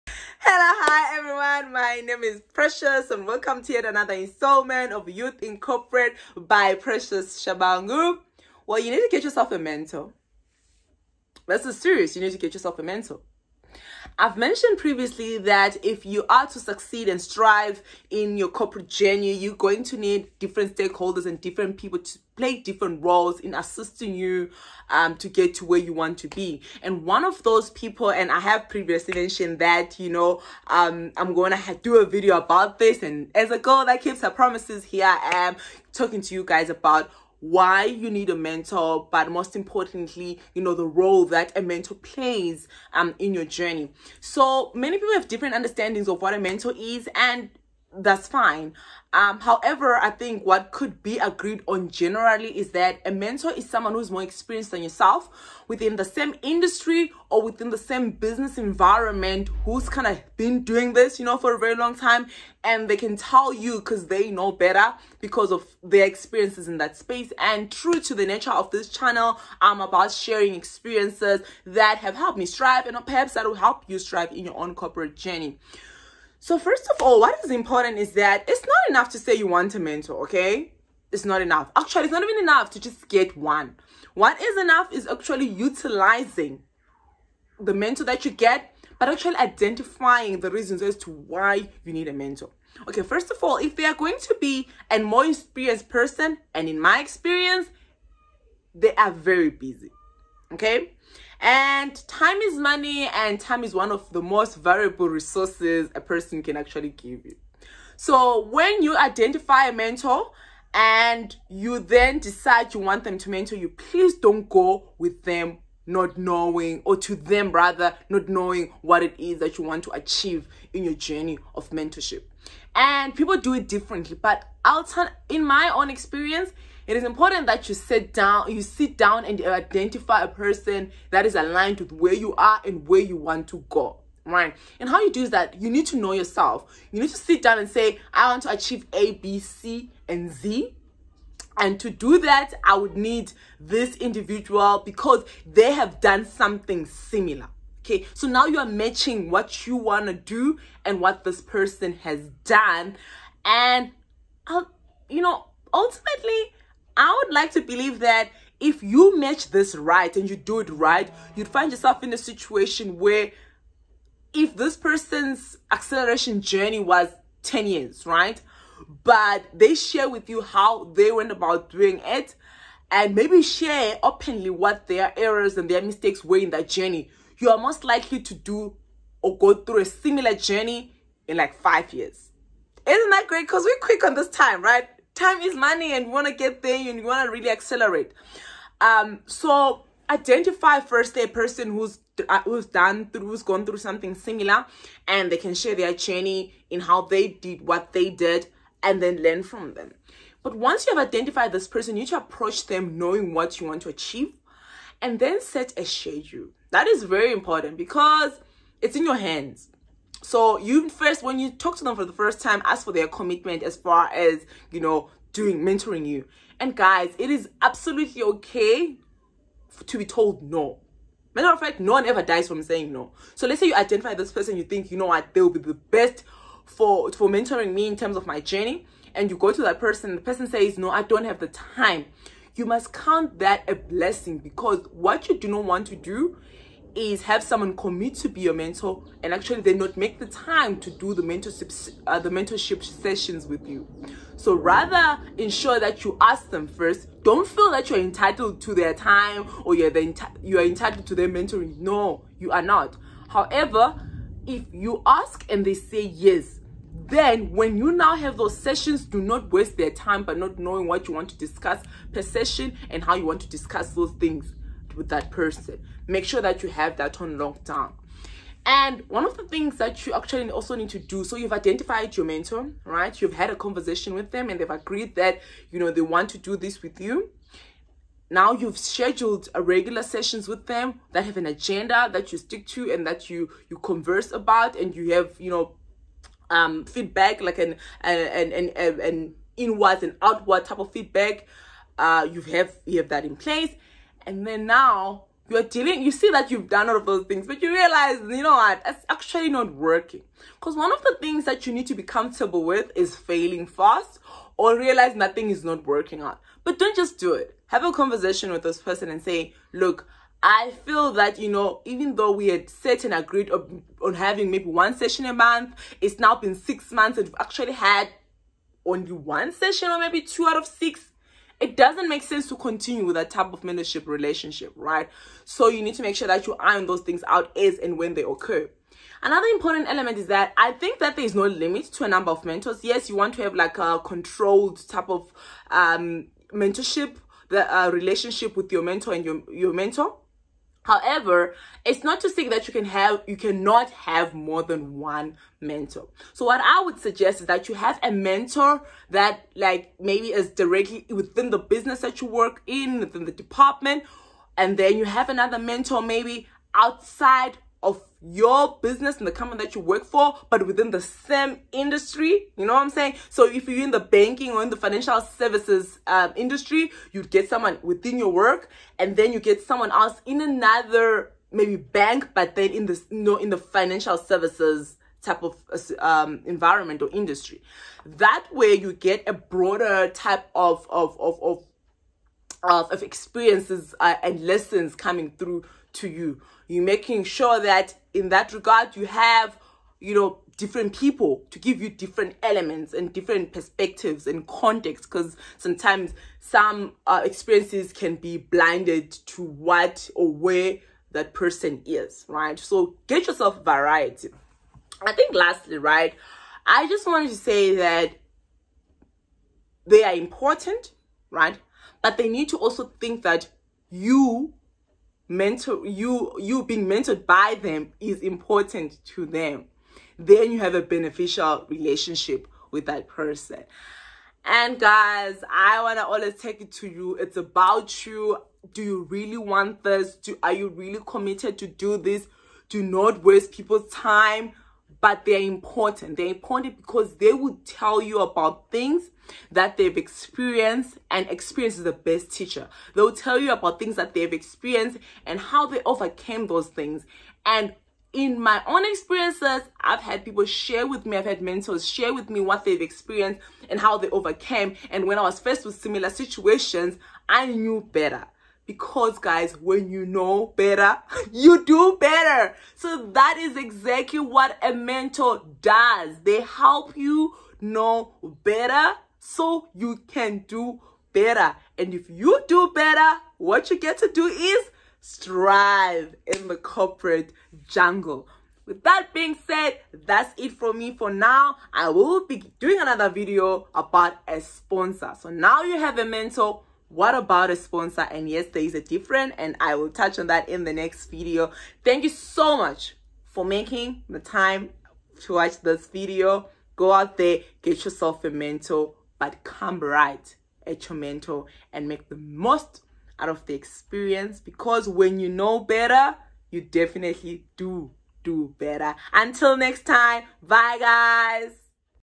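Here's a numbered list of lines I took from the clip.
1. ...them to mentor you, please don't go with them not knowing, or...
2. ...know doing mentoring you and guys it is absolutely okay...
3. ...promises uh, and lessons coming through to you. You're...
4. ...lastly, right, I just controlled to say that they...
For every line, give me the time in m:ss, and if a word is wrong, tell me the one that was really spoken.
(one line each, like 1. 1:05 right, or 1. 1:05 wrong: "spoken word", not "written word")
1. 1:53 right
2. 3:34 right
3. 6:23 wrong: "experiences", not "promises"
4. 6:45 wrong: "wanted", not "controlled".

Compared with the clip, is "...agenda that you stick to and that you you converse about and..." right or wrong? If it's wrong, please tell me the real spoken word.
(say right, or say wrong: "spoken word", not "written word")
right.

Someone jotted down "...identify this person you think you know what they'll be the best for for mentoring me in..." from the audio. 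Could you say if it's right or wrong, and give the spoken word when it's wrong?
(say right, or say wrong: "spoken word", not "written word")
right.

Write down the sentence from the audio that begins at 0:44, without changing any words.
So many people have different understandings of what a mentor is, and that's fine.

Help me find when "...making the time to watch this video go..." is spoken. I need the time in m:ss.
8:13.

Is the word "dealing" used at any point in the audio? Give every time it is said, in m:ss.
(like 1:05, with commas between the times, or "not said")
4:55.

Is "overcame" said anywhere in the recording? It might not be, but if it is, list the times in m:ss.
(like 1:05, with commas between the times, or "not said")
7:25, 7:34.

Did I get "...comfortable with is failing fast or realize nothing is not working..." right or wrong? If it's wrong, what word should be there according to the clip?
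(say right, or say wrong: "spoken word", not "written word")
right.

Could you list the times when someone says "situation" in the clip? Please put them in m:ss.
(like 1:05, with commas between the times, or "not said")
2:42, 7:36.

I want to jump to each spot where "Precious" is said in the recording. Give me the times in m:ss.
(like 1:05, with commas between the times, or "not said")
0:02, 0:06.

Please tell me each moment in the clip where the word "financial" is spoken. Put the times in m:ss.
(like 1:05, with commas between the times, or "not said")
6:04, 6:13.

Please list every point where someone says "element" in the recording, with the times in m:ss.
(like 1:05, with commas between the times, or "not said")
5:29, 6:32.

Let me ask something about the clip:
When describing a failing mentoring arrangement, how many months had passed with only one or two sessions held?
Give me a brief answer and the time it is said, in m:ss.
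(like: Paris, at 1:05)
6, at 5:16.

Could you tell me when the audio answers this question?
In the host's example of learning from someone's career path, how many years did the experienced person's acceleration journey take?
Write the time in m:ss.
2:47.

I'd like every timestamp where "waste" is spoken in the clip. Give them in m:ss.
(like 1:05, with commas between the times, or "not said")
4:19, 7:13.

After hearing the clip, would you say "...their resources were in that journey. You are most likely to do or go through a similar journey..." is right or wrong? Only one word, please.
wrong.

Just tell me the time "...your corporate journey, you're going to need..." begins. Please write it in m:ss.
0:18.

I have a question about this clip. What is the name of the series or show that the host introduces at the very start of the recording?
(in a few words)
Youth in Corporate.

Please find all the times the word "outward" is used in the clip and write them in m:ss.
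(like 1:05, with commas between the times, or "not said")
4:50.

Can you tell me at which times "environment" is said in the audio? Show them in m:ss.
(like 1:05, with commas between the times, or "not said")
0:58, 6:16.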